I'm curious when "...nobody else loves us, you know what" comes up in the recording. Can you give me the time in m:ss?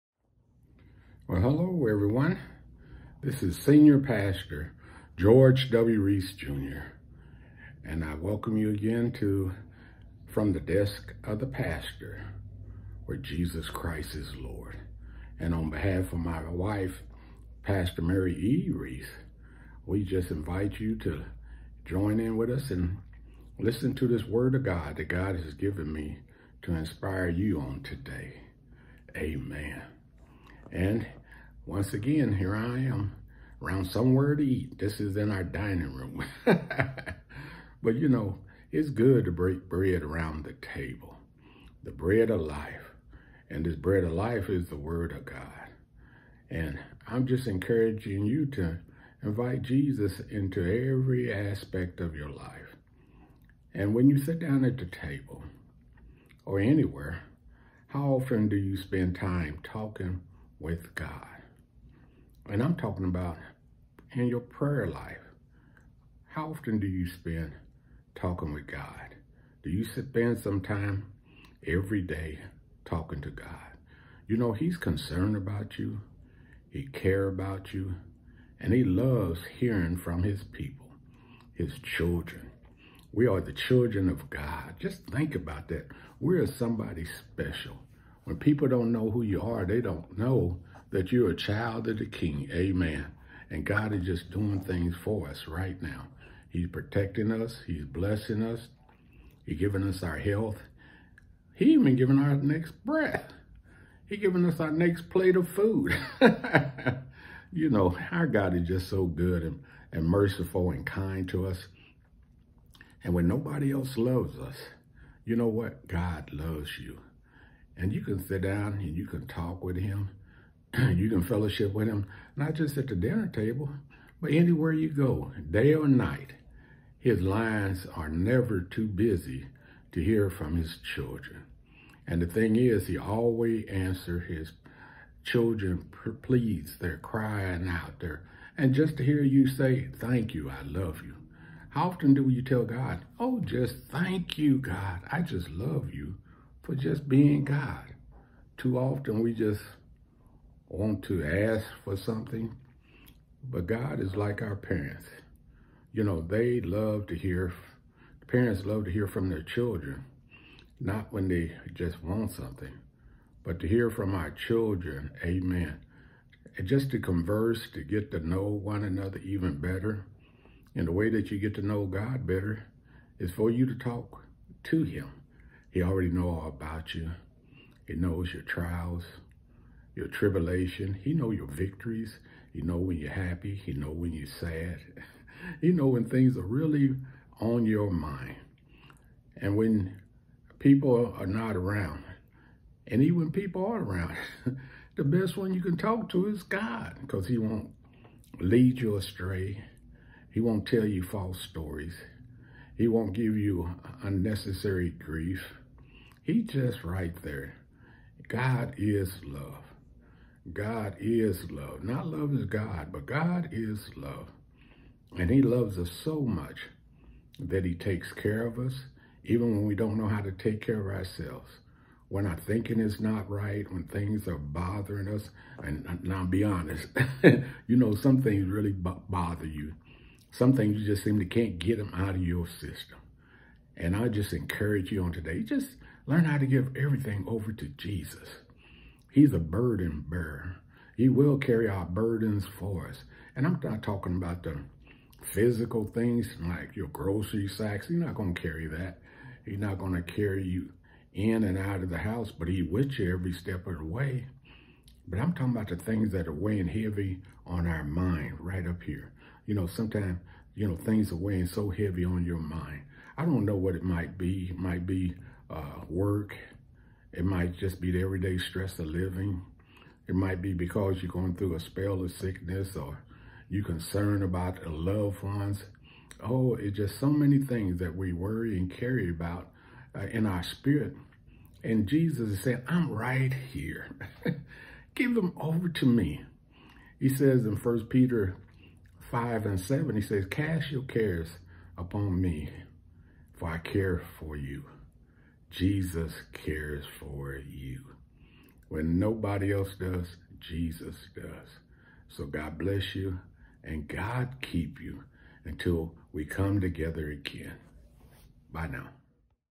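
1:53.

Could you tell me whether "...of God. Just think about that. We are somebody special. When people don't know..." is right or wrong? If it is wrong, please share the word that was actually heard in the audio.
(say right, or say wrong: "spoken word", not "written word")
right.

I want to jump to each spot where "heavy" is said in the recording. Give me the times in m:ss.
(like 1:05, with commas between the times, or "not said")
4:16, 4:21.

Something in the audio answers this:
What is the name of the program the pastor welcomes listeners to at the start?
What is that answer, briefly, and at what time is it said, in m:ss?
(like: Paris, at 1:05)
From the Desk of the Pastor, at 0:10.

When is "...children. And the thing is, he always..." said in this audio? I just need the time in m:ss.
2:10.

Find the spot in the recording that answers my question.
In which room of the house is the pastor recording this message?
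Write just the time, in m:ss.
0:35.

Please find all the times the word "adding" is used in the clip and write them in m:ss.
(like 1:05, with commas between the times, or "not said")
not said.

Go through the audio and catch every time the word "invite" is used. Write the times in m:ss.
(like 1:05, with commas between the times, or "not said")
0:20, 0:49.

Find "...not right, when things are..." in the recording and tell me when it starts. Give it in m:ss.
3:42.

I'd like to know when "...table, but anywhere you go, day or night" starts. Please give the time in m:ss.
2:03.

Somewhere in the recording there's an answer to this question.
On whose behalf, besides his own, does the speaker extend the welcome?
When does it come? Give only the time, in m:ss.
0:17.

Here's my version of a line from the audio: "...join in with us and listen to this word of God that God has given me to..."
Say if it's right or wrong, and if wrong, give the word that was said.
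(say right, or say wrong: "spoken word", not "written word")
right.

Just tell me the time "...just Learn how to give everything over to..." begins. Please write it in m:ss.
3:55.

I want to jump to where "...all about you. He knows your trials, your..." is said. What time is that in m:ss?
2:56.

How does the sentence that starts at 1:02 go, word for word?
And I'm talking about in your prayer life.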